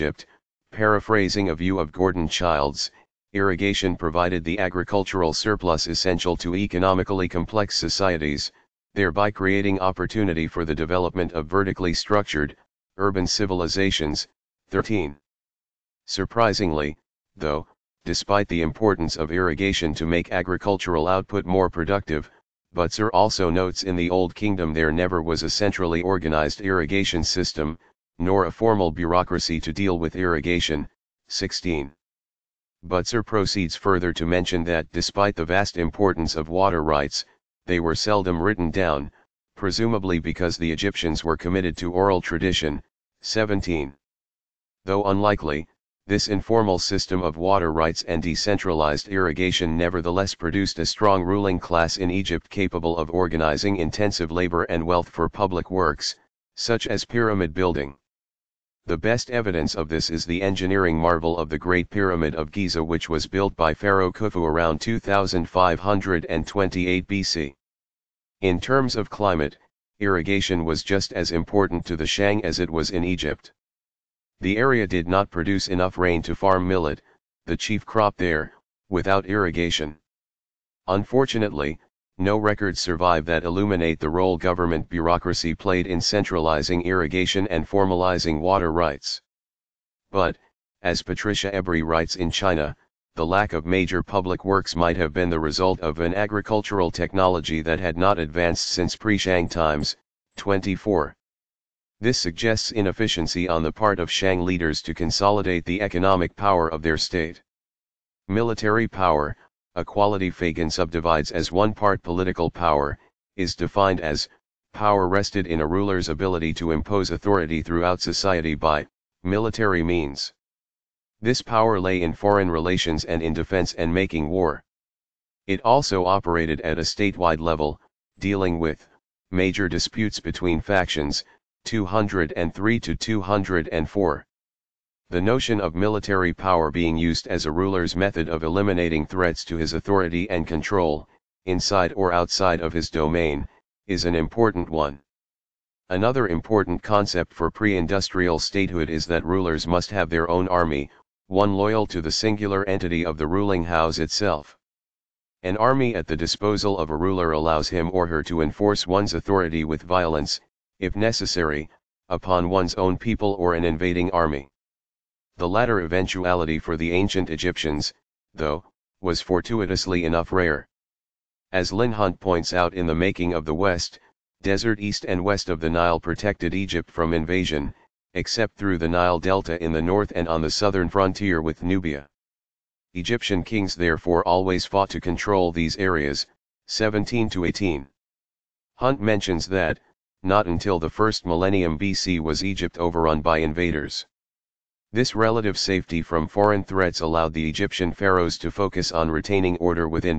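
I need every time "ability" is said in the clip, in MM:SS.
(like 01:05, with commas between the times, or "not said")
01:56.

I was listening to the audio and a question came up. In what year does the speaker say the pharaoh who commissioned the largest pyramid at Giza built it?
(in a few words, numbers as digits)
2528 BC.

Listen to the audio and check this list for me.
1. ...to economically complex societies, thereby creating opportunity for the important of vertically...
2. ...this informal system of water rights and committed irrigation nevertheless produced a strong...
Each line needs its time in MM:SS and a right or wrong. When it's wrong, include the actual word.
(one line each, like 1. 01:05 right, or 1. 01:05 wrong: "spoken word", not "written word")
1. 00:06 wrong: "development", not "important"
2. 00:46 wrong: "decentralized", not "committed".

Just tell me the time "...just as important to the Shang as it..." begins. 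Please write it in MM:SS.
01:10.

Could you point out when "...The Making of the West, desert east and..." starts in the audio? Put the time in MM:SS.
02:52.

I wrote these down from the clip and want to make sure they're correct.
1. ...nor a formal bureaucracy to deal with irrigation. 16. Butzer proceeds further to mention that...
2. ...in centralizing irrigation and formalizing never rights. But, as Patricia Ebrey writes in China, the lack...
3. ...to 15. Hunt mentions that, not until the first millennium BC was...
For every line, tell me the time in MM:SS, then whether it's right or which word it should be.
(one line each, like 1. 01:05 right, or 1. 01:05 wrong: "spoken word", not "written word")
1. 00:28 right
2. 01:25 wrong: "water", not "never"
3. 03:07 wrong: "18", not "15".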